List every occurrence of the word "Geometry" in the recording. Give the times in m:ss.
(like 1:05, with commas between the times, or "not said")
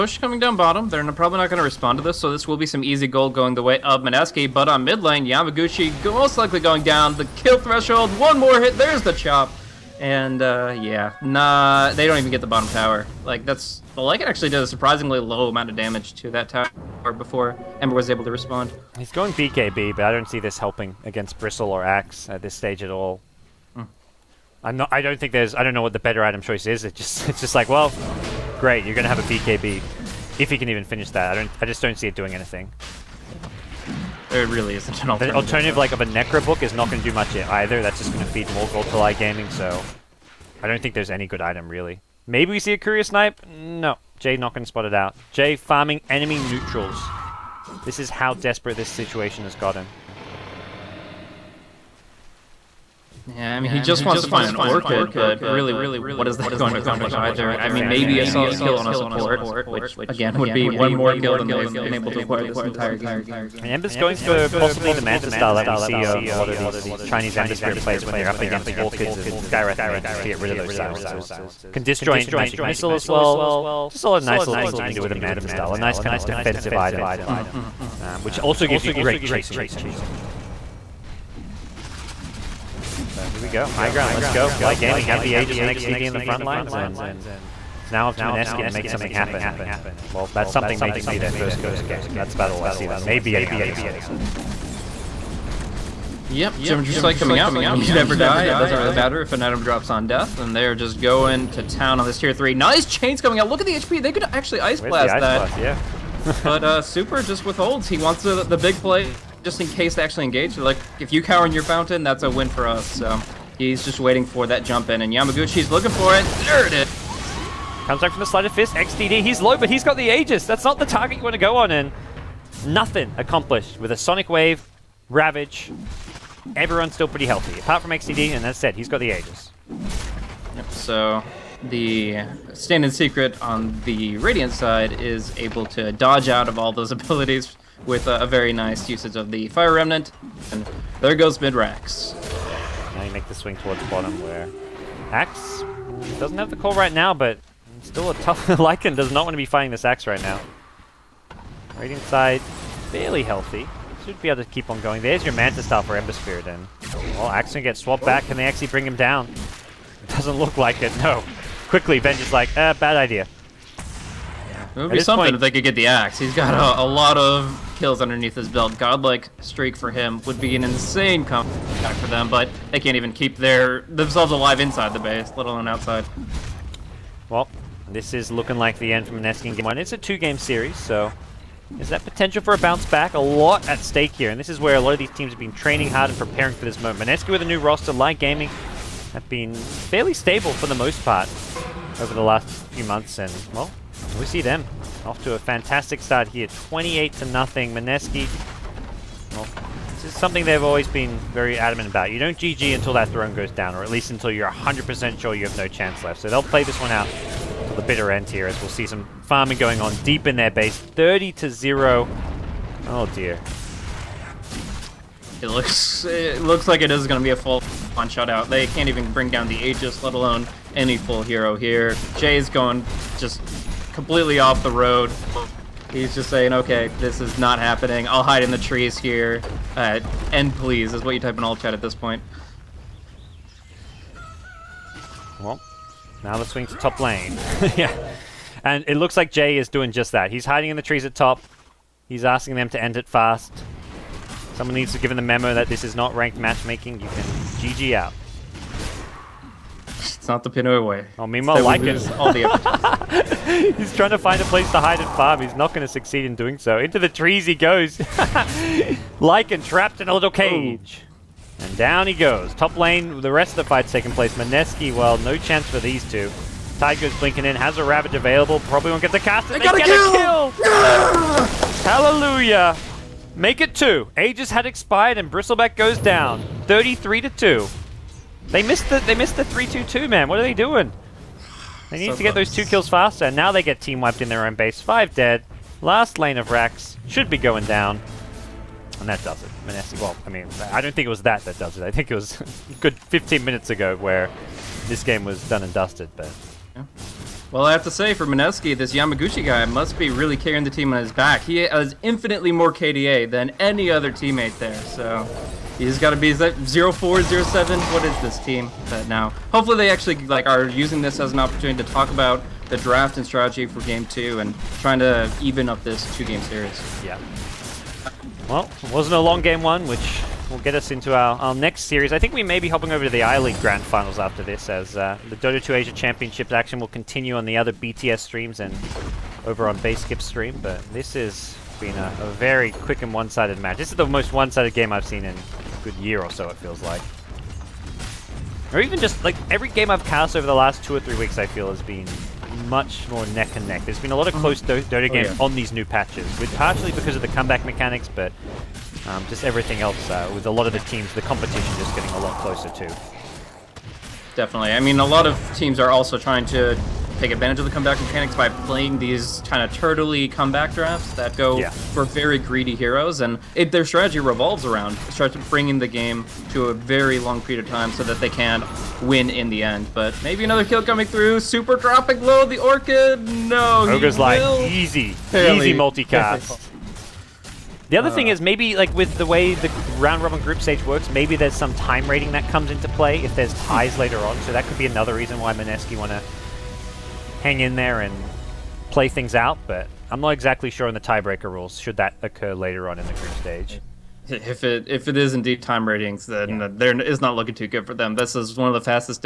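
1:36.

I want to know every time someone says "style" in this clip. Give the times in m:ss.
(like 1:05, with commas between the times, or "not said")
1:05, 1:15, 2:35.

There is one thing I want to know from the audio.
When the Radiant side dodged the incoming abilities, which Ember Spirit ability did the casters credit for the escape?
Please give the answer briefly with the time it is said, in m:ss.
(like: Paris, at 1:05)
Fire Remnant, at 2:19.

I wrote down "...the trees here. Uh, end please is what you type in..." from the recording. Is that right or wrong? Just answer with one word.
right.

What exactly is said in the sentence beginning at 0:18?
He's going BKB, but I don't see this helping against Bristle or Axe at this stage at all.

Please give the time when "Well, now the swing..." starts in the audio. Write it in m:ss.
3:55.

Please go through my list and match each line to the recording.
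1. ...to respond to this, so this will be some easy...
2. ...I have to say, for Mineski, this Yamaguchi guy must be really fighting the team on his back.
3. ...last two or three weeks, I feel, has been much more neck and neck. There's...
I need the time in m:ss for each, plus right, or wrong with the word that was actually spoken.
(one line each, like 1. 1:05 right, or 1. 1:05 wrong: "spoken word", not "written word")
1. 0:01 right
2. 4:57 wrong: "carrying", not "fighting"
3. 5:40 right.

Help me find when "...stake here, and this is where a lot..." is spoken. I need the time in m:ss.
3:03.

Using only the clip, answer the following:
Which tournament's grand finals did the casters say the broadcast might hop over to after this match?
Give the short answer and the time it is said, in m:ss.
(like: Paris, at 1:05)
I-League, at 5:23.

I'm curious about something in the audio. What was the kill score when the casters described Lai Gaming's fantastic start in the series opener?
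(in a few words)
28 to 0.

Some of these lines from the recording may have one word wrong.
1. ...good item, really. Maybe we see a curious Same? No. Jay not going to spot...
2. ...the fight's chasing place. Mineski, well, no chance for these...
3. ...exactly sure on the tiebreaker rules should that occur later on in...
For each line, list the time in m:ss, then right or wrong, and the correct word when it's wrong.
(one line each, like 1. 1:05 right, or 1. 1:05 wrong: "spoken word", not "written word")
1. 0:41 wrong: "Snipe", not "Same"
2. 4:23 wrong: "taking", not "chasing"
3. 6:30 right.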